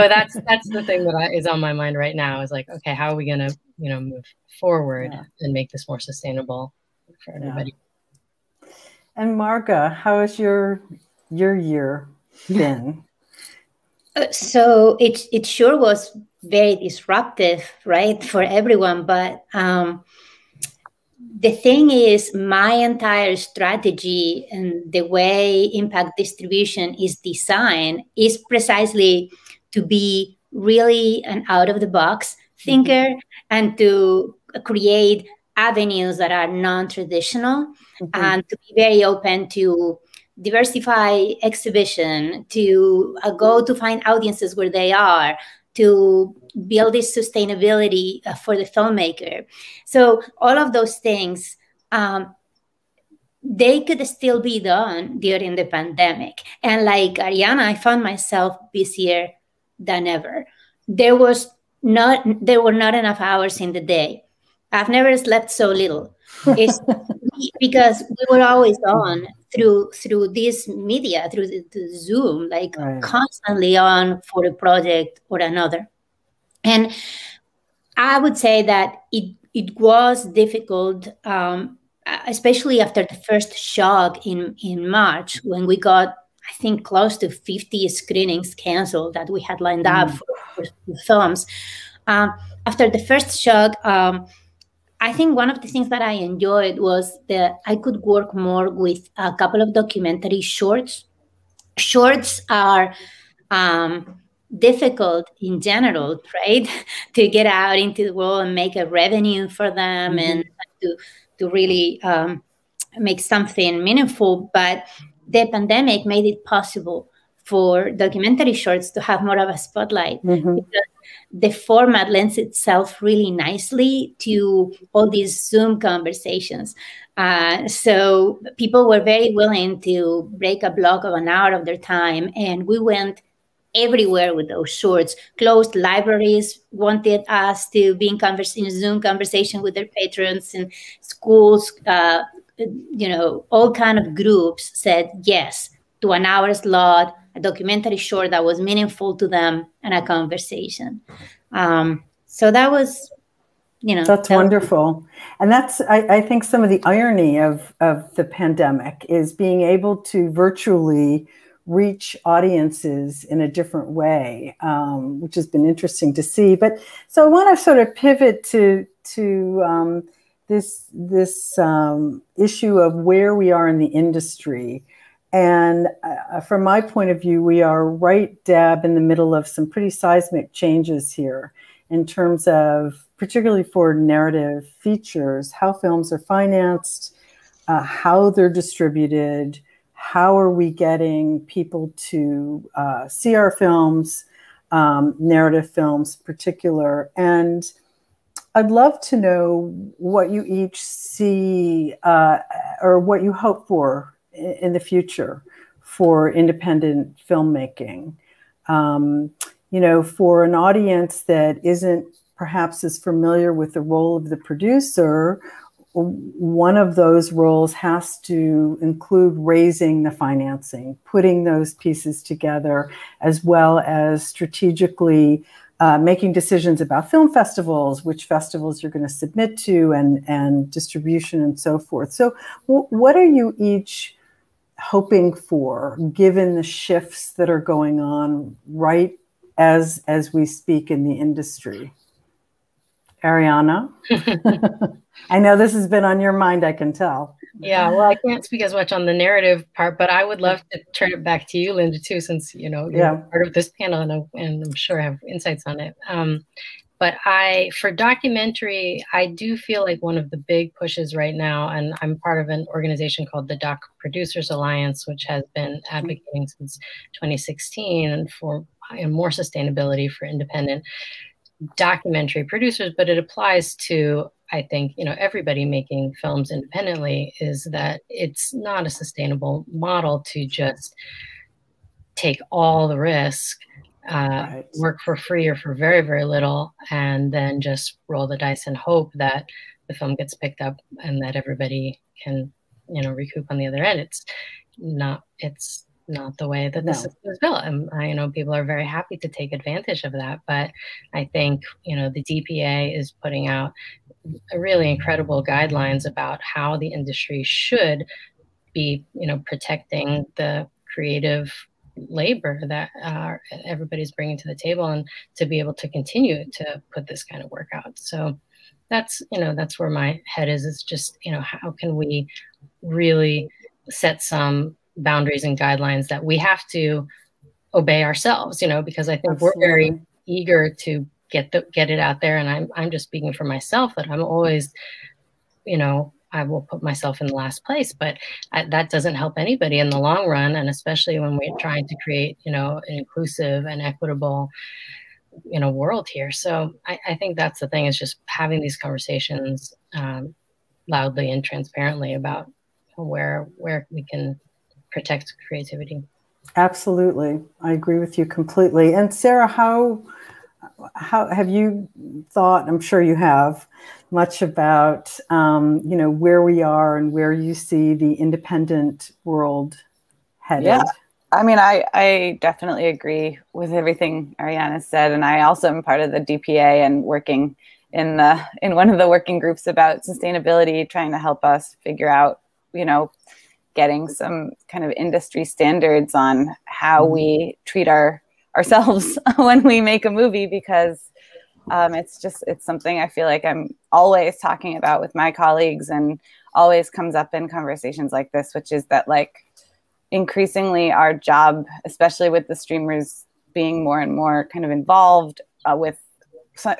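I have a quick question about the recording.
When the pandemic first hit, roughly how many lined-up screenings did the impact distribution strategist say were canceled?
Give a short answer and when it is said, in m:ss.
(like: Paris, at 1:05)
50, at 1:27.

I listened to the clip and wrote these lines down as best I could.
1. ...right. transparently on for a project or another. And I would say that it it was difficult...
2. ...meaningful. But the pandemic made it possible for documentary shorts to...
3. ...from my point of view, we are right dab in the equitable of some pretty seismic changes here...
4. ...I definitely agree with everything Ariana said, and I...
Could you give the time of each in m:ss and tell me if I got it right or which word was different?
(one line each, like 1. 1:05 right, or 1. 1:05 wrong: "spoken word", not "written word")
1. 1:12 wrong: "constantly", not "transparently"
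2. 1:53 right
3. 2:56 wrong: "middle", not "equitable"
4. 6:11 right.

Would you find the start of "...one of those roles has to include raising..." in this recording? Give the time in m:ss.
3:35.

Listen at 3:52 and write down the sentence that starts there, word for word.
So, what are you each hoping for, given the shifts that are going on right as as we speak in the industry?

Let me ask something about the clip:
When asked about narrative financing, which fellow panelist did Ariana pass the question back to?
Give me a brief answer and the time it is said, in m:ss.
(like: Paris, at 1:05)
Linda, at 4:11.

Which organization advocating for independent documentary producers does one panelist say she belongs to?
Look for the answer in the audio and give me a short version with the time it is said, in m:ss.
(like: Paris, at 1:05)
Doc Producers Alliance, at 4:23.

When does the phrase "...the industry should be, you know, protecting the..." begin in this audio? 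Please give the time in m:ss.
5:06.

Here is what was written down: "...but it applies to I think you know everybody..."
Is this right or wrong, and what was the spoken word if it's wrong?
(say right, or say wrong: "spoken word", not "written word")
right.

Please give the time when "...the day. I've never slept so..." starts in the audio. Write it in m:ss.
1:03.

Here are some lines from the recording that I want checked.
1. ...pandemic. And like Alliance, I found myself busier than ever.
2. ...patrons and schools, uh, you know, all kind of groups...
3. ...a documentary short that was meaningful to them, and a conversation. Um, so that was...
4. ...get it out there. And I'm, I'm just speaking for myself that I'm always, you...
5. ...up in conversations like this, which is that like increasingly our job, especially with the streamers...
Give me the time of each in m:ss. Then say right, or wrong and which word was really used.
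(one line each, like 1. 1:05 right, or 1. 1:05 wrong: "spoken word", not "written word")
1. 0:55 wrong: "Ariana", not "Alliance"
2. 2:19 right
3. 2:27 right
4. 5:31 right
5. 6:37 right.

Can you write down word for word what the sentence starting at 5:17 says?
So that's, you know, that's where my head is.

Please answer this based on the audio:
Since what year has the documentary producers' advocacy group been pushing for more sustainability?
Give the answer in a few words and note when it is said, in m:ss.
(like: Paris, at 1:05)
2016, at 4:27.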